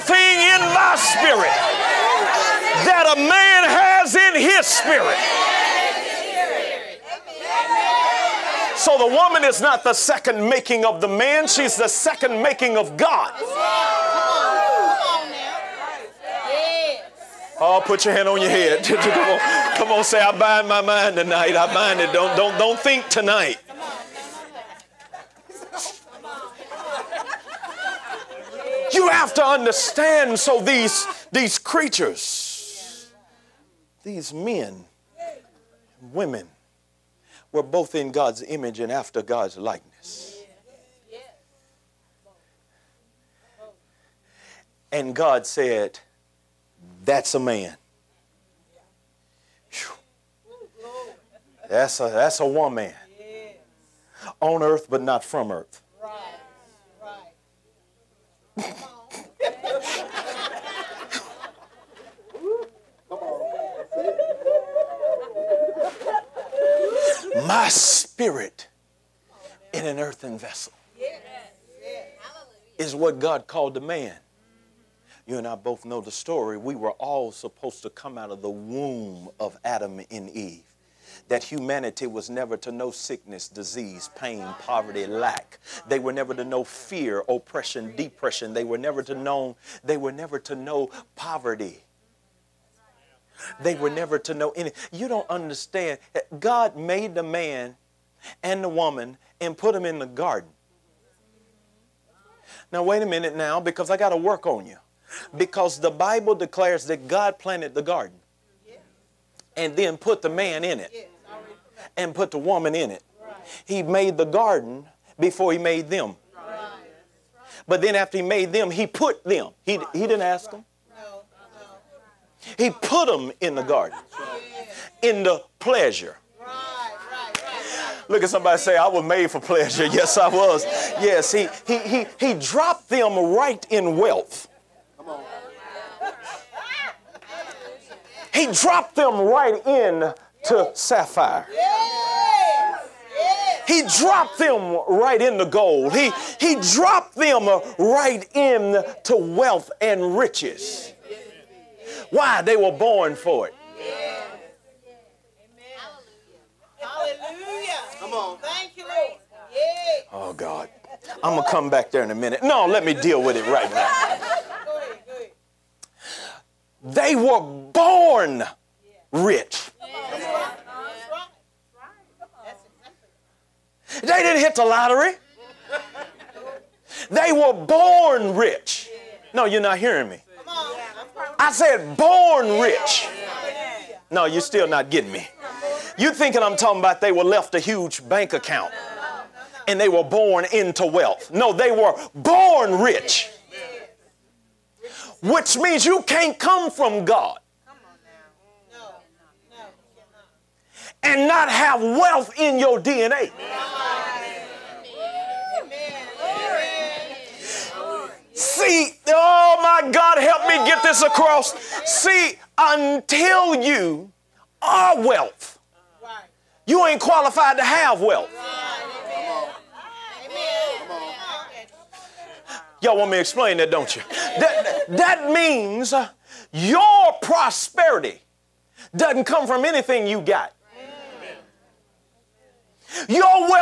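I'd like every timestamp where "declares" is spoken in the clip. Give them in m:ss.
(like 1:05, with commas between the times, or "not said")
1:46.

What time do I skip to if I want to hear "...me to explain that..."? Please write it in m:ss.
3:43.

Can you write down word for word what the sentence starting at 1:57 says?
But then after he made them, he put them.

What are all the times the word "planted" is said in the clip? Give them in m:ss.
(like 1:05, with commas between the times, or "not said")
1:47.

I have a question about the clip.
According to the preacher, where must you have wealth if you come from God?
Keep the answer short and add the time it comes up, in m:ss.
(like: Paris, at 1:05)
In your DNA, at 3:22.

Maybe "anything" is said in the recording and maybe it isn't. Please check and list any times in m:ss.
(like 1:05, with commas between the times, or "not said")
1:34, 3:49.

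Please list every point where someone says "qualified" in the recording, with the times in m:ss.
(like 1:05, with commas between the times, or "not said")
3:37.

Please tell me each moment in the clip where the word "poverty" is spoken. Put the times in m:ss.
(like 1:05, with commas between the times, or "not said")
1:24, 1:31.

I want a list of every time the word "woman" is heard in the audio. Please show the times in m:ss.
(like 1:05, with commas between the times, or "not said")
0:09, 0:52, 1:38, 1:52.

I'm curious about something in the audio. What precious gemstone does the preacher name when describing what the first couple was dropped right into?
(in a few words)
Sapphire.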